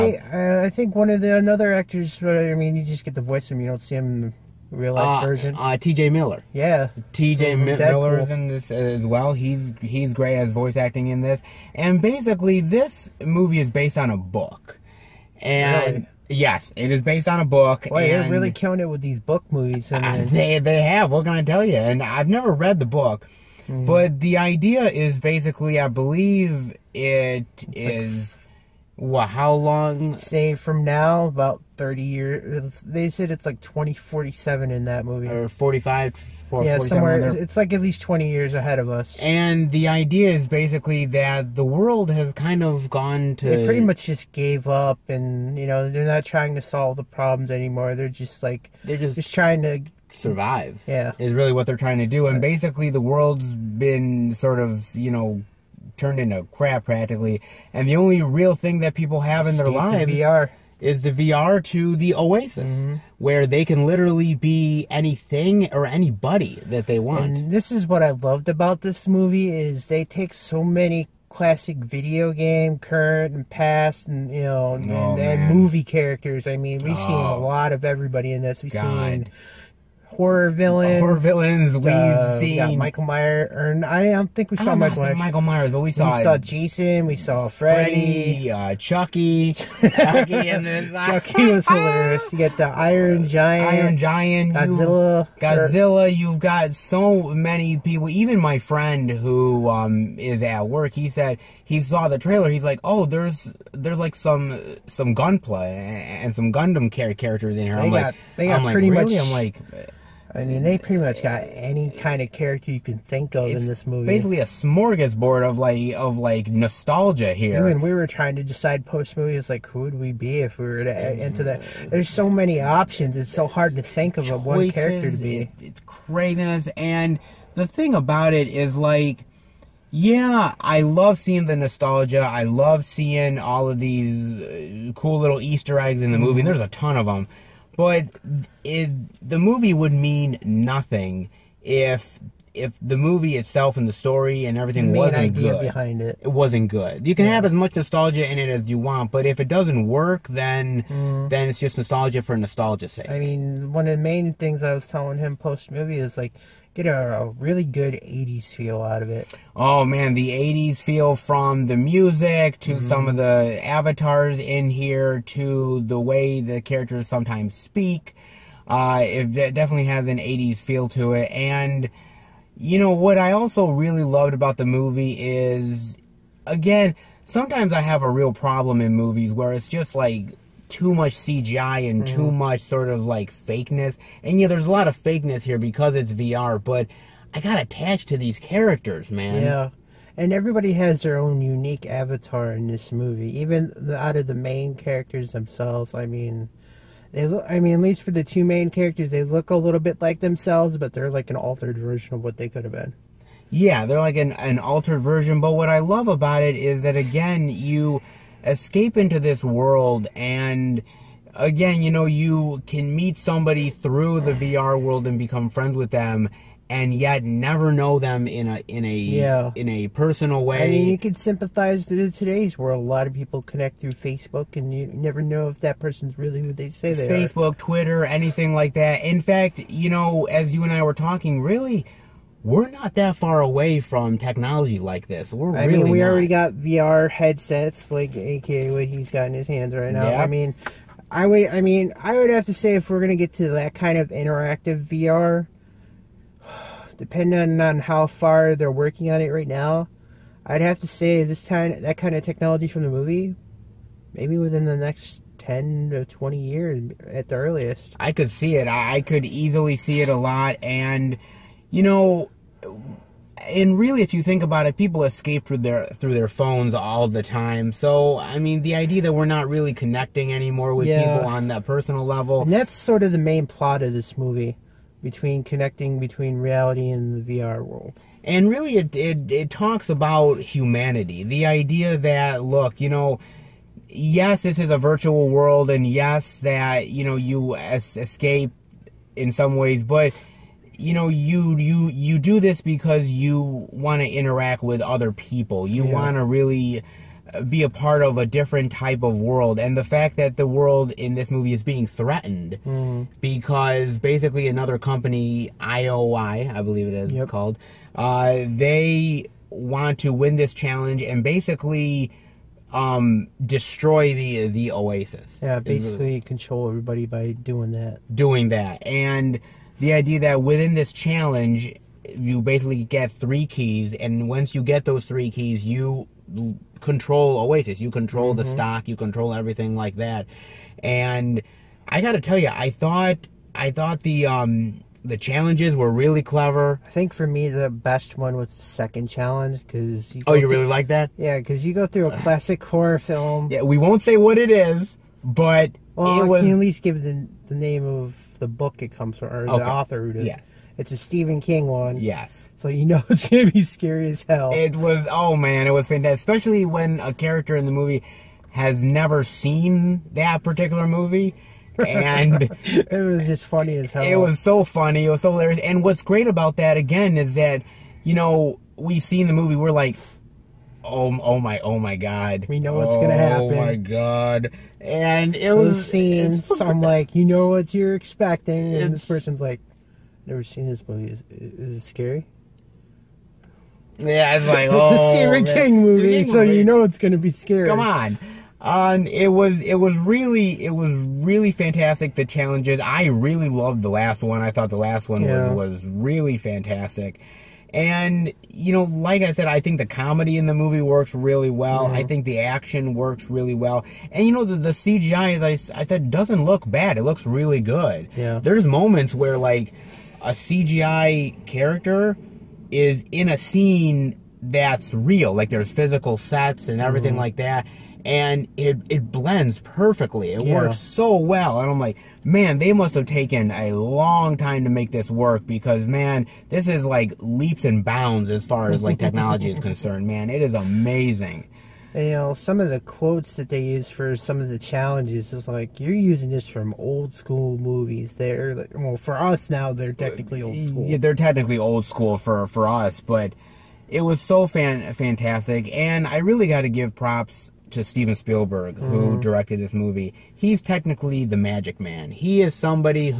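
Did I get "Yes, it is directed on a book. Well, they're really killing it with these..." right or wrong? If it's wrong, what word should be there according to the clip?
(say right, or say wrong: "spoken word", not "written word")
wrong: "based", not "directed".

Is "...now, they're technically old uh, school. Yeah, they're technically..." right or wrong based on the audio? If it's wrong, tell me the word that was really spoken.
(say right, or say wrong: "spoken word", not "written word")
right.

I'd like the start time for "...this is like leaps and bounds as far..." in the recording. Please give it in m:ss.
7:06.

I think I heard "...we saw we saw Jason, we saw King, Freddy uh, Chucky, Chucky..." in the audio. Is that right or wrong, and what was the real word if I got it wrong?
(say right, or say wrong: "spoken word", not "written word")
wrong: "Freddy", not "King".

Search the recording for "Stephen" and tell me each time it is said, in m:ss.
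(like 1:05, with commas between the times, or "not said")
5:50, 6:25.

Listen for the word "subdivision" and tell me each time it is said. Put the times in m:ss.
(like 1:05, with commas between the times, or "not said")
not said.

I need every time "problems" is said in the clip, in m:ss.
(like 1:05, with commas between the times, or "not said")
0:47, 2:58.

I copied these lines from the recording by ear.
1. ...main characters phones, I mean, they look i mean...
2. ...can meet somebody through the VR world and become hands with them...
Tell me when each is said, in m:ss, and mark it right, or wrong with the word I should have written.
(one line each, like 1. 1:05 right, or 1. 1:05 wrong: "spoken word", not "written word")
1. 3:14 wrong: "themselves", not "phones"
2. 3:32 wrong: "friends", not "hands".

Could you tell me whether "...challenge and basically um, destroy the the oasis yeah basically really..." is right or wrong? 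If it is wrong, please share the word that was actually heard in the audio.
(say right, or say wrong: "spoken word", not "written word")
right.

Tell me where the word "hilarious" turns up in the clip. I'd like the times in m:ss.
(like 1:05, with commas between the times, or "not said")
1:31, 6:05.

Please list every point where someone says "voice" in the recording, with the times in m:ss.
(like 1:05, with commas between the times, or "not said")
0:03, 0:10.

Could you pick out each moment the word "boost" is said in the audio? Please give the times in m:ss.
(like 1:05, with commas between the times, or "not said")
not said.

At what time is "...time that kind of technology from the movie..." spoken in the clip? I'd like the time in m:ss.
4:11.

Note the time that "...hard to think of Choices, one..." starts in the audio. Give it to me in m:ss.
2:03.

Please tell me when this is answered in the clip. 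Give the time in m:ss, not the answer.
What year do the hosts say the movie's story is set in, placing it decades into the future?
0:33.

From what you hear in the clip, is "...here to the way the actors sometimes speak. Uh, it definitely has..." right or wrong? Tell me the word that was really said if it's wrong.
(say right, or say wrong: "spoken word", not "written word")
wrong: "characters", not "actors".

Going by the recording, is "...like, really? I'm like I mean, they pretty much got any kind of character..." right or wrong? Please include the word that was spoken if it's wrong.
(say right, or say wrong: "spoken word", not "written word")
right.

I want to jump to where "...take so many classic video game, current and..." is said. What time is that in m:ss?
1:10.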